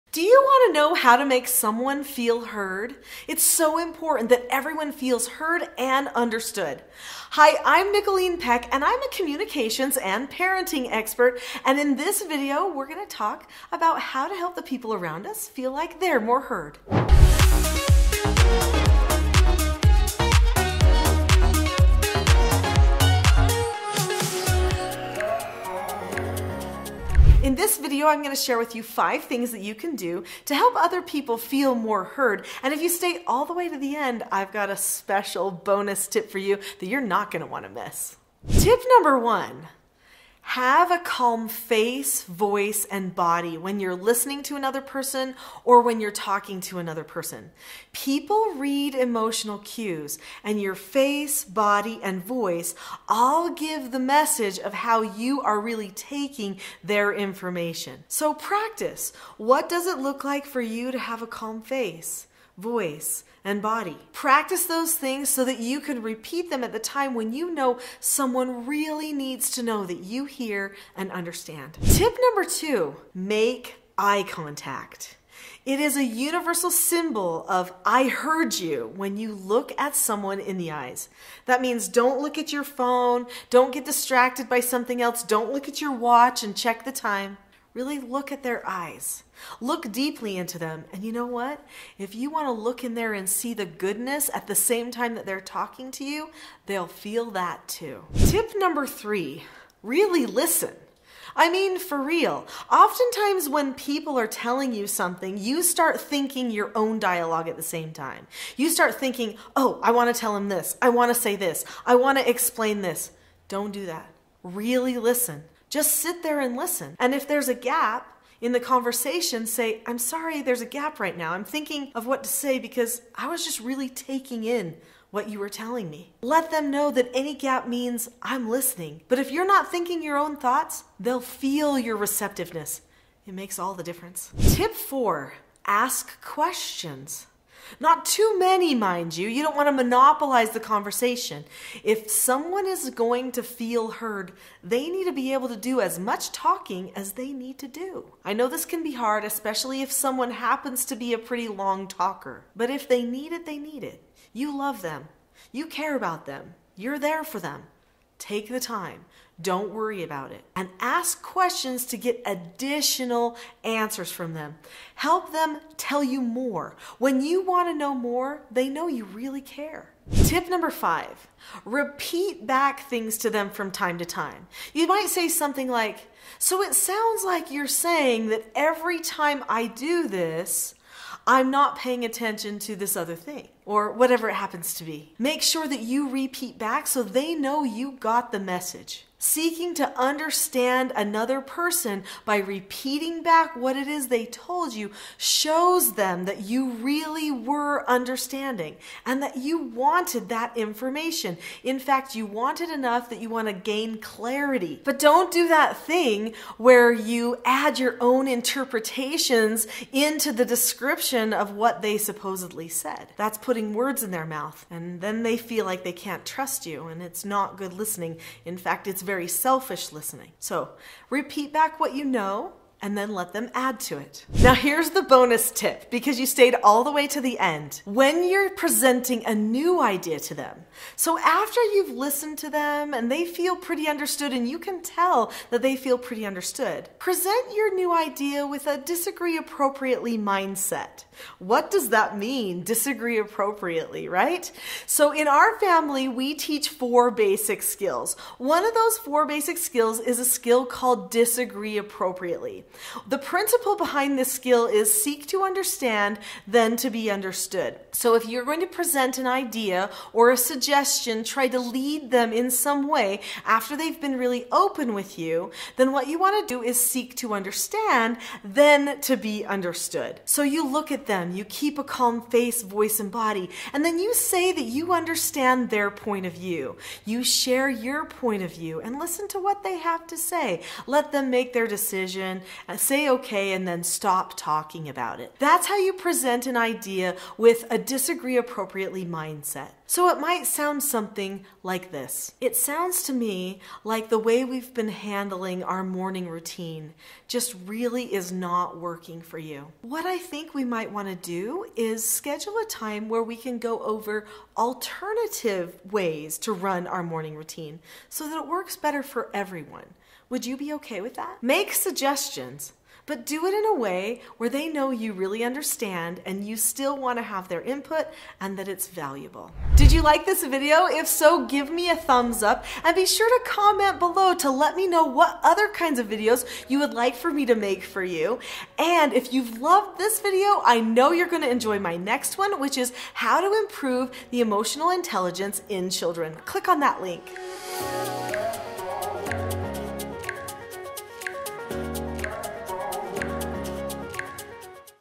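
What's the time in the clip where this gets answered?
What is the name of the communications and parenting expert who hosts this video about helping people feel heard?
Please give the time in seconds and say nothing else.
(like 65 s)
7 s.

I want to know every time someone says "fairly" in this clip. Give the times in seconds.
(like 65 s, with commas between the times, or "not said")
not said.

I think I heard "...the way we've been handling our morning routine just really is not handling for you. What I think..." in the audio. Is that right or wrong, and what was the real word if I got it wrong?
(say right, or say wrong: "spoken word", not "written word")
wrong: "working", not "handling".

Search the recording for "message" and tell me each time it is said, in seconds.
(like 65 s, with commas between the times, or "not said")
53 s, 188 s.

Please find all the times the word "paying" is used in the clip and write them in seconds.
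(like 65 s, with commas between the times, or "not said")
181 s.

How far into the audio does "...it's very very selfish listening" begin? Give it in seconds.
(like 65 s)
218 s.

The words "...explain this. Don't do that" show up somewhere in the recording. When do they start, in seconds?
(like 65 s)
112 s.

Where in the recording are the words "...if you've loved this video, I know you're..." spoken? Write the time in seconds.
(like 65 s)
329 s.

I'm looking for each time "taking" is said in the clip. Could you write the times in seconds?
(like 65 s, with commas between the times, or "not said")
55 s, 123 s.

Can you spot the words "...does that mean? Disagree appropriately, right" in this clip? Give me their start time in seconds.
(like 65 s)
241 s.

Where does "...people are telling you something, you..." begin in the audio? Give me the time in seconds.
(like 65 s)
103 s.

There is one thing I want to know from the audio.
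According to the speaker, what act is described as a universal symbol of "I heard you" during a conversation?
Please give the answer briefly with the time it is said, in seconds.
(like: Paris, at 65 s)
eye contact, at 73 s.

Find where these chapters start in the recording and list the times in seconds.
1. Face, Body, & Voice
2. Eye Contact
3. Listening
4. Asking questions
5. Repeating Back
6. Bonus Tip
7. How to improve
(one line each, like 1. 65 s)
1. 39 s
2. 71 s
3. 98 s
4. 134 s
5. 170 s
6. 224 s
7. 319 s.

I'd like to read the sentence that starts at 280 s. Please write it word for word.
Let them make their decision say okay, and then stop talking about it.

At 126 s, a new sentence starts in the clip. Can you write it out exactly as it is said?
Let them know that any gap means I'm listening.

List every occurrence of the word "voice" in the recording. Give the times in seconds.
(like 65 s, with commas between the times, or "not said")
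42 s, 52 s, 62 s, 272 s.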